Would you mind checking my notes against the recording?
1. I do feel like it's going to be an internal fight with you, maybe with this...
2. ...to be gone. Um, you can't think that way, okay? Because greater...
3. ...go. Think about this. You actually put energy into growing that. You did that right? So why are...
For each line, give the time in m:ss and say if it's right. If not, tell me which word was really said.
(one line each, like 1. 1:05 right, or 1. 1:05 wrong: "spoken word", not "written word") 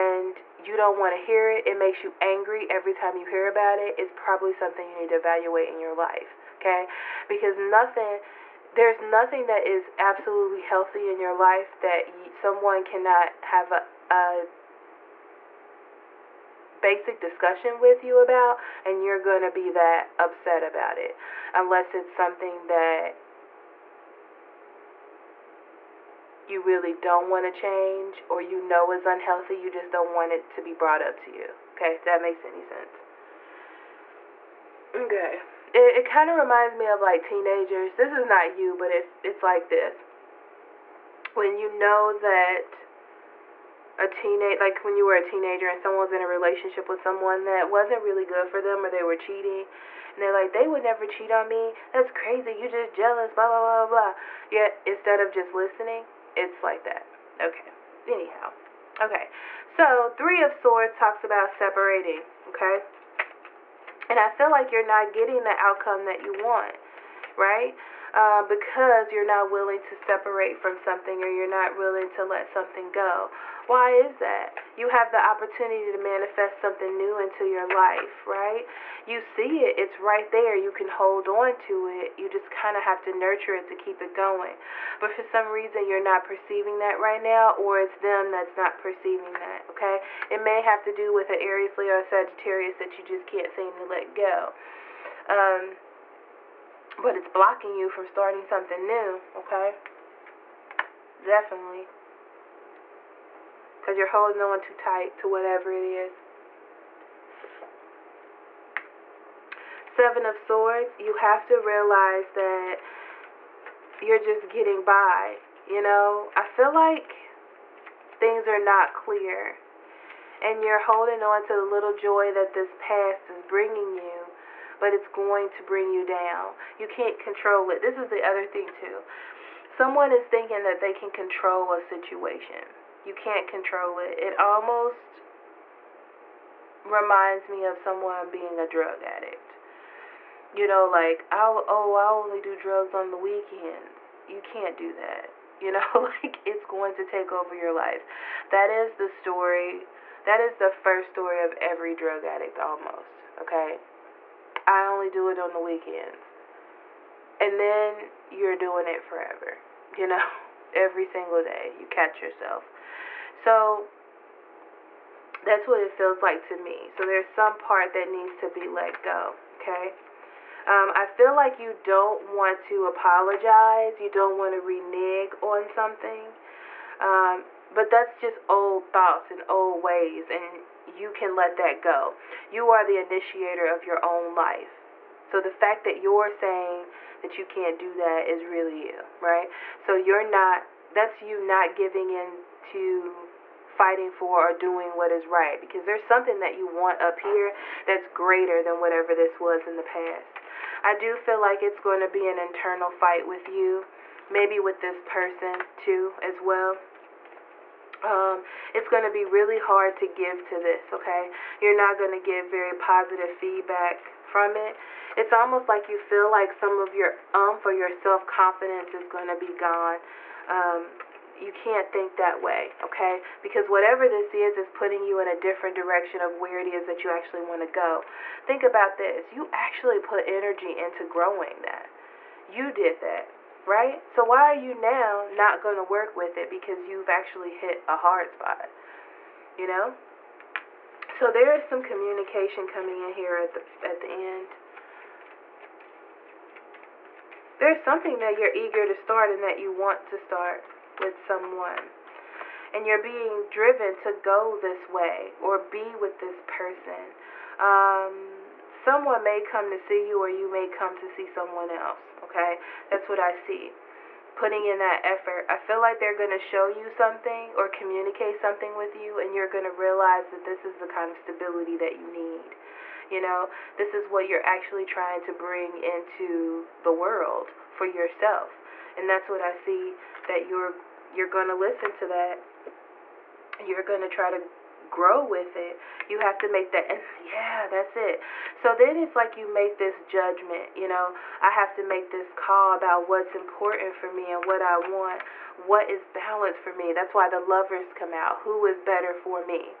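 1. 3:20 right
2. 3:39 wrong: "whatever", not "greater"
3. 3:47 right.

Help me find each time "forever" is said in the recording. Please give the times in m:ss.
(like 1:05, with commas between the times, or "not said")
2:39.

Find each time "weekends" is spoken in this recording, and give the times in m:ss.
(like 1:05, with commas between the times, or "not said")
2:23, 2:35.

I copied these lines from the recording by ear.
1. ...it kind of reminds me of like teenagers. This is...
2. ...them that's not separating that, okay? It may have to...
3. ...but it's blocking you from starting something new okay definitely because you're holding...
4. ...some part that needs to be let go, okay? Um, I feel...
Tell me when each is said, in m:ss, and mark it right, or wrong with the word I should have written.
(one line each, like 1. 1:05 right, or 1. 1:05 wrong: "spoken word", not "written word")
1. 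0:35 right
2. 1:27 wrong: "perceiving", not "separating"
3. 1:36 right
4. 2:47 right.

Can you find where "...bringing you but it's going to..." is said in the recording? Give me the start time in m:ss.
2:03.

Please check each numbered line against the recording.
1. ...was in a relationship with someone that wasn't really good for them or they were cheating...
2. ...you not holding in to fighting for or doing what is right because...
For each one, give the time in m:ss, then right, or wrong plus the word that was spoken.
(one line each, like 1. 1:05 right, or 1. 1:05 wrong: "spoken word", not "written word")
1. 0:46 right
2. 3:11 wrong: "giving", not "holding".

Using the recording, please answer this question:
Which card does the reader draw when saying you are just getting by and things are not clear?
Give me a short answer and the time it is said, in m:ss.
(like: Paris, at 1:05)
Seven of Swords, at 1:49.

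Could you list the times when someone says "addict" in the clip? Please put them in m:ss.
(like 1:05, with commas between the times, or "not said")
2:19, 2:32.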